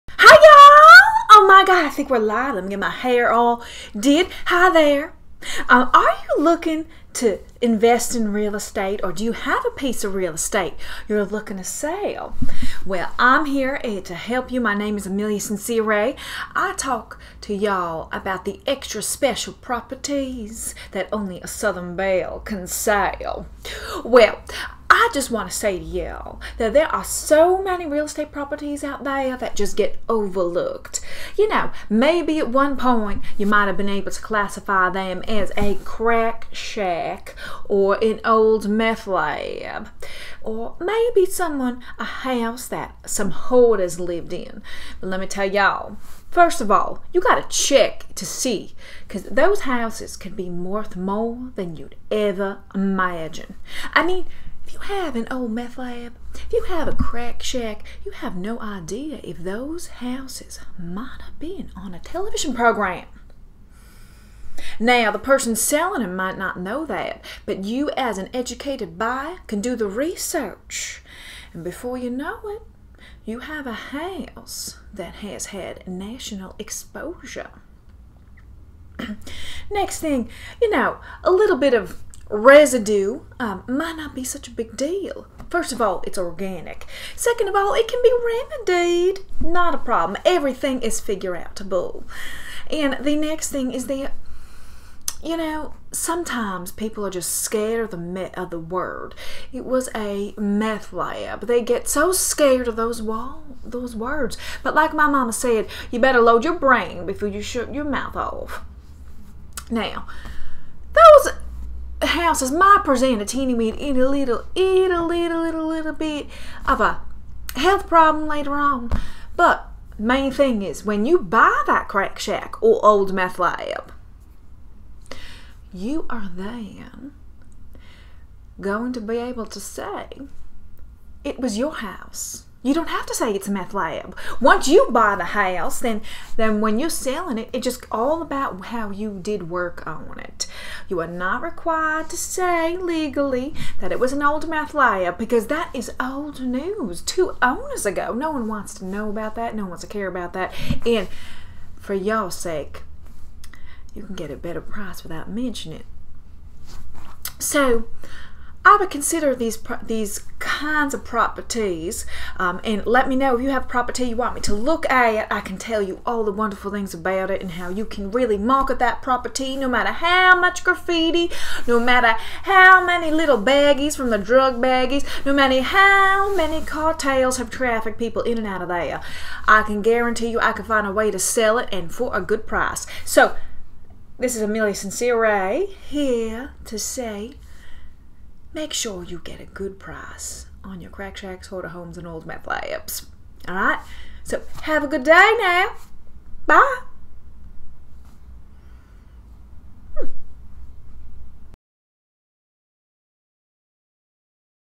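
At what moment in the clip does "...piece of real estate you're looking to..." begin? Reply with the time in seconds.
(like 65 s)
9 s.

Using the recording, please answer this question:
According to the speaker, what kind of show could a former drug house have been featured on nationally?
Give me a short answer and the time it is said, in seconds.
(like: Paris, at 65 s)
a television program, at 61 s.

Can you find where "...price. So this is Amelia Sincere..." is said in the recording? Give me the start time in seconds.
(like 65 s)
182 s.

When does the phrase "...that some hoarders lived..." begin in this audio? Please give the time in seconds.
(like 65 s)
42 s.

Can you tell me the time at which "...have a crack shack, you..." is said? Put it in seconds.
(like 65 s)
56 s.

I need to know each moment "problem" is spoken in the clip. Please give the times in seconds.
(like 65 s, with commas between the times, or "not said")
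89 s, 117 s.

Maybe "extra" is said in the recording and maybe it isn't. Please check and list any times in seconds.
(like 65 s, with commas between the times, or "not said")
18 s.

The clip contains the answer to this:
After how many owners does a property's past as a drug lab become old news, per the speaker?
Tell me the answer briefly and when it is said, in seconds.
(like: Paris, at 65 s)
2, at 147 s.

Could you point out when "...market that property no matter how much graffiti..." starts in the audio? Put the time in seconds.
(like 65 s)
168 s.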